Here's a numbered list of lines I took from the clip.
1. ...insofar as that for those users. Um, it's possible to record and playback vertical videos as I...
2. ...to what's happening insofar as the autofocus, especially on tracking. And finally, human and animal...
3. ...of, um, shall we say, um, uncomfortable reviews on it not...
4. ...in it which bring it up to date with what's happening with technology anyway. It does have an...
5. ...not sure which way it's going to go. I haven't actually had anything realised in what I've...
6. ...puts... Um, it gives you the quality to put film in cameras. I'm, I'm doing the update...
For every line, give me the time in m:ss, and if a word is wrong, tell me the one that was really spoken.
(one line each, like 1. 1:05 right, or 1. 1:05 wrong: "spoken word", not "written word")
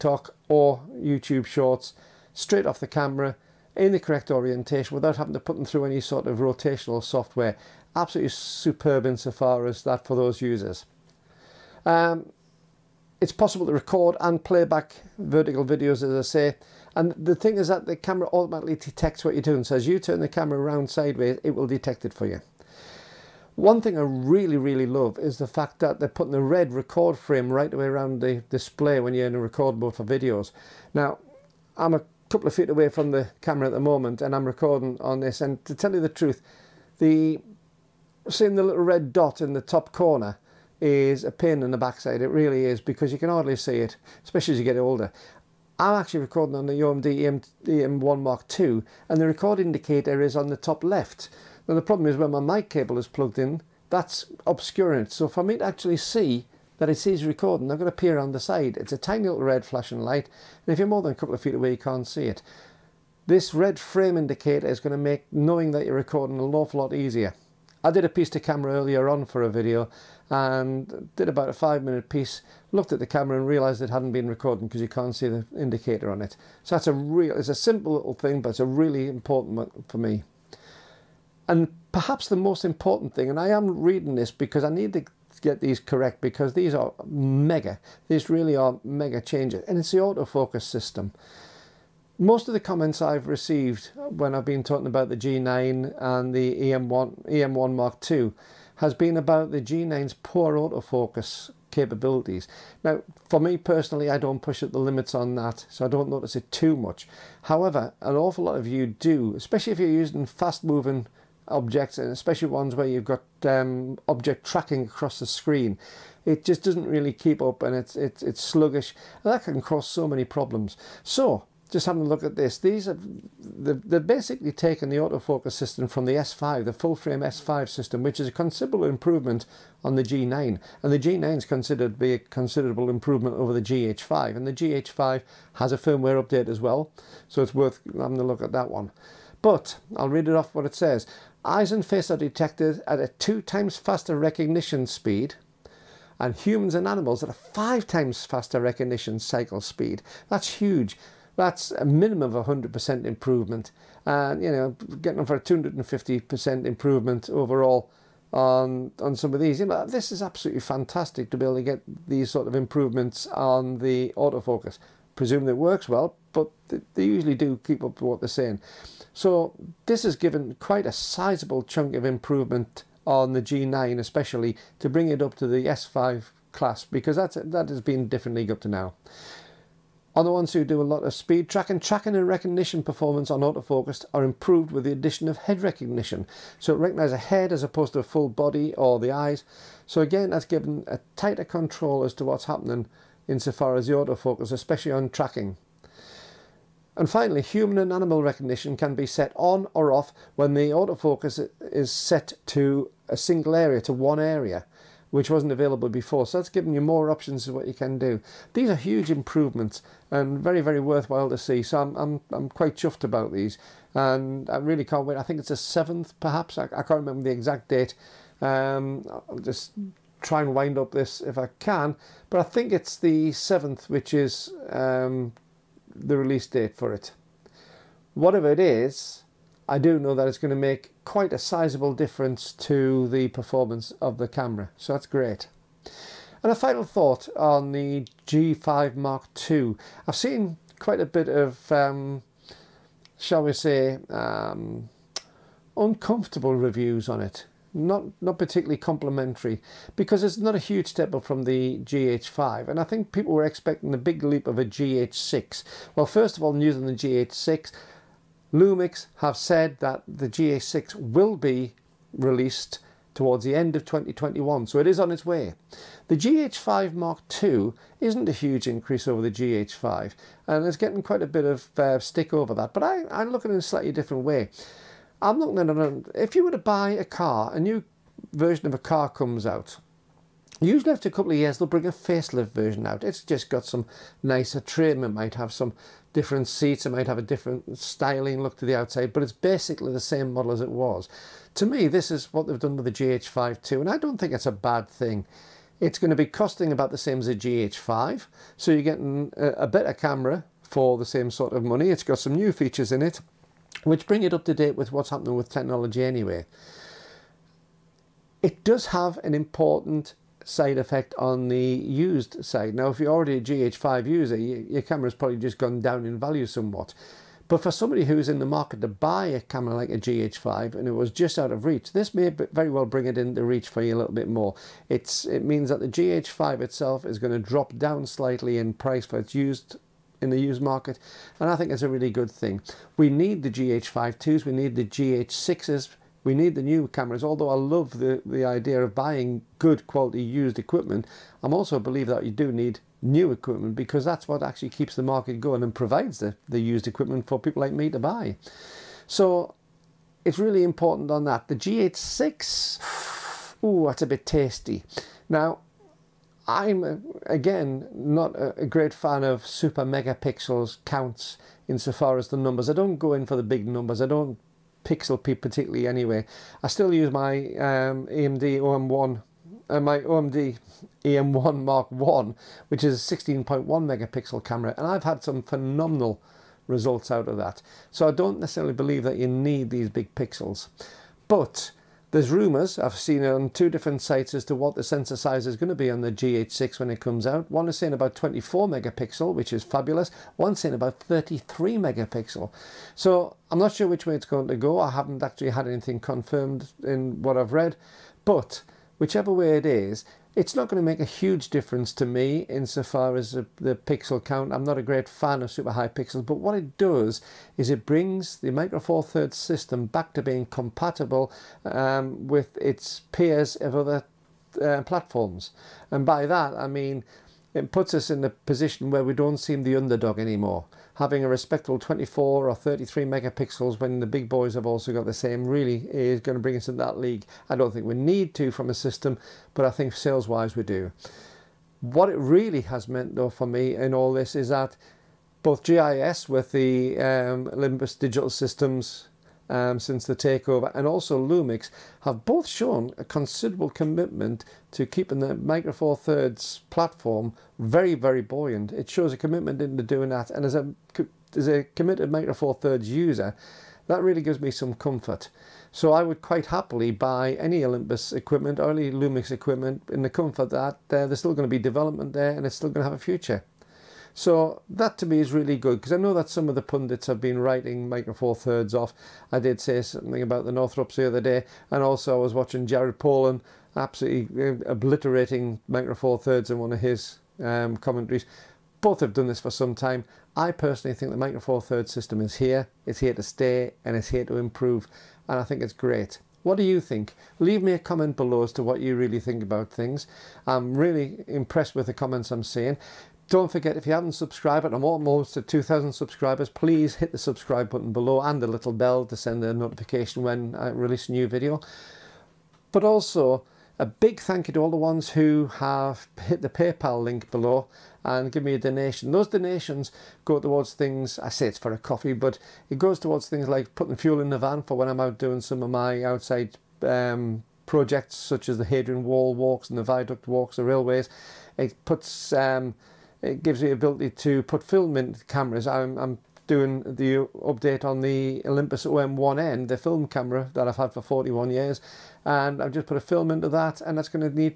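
1. 0:09 right
2. 3:12 right
3. 4:01 right
4. 5:02 right
5. 6:33 wrong: "confirmed", not "realised"
6. 8:41 wrong: "ability", not "quality".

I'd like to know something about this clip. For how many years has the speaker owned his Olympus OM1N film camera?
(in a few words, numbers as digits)
41 years.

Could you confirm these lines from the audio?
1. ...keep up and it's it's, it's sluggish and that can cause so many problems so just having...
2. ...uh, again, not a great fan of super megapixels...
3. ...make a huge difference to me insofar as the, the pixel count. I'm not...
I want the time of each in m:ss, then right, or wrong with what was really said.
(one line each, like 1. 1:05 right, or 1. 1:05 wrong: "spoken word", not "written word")
1. 1:57 right
2. 5:56 right
3. 6:40 right.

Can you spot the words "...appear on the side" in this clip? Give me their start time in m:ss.
0:57.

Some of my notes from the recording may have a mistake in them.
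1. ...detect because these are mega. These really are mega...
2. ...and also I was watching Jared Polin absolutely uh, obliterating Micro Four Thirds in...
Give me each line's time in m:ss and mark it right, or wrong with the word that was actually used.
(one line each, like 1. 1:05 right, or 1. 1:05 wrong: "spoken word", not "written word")
1. 1:25 wrong: "correct", not "detect"
2. 7:51 right.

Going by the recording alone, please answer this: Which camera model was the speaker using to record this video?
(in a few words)
OMD EM1 Mark II.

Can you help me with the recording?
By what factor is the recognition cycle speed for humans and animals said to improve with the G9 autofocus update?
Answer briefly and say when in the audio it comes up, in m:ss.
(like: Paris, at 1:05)
5 times, at 2:27.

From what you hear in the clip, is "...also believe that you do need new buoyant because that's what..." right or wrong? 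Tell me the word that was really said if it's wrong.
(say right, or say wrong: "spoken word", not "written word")
wrong: "equipment", not "buoyant".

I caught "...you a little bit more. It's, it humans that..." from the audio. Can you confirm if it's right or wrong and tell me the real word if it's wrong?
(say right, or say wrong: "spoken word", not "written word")
wrong: "means", not "humans".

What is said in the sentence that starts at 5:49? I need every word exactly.
So it's really important on that.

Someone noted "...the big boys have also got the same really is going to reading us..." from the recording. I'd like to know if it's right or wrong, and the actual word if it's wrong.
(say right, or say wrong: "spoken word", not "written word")
wrong: "bring", not "reading".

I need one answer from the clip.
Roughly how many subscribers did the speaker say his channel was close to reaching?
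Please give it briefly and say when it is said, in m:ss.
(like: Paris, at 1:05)
2,000, at 8:15.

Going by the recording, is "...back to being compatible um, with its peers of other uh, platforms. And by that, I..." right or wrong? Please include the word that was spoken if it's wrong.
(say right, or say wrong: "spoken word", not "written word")
right.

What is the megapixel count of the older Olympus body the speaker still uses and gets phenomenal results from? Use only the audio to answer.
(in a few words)
16.1 megapixels.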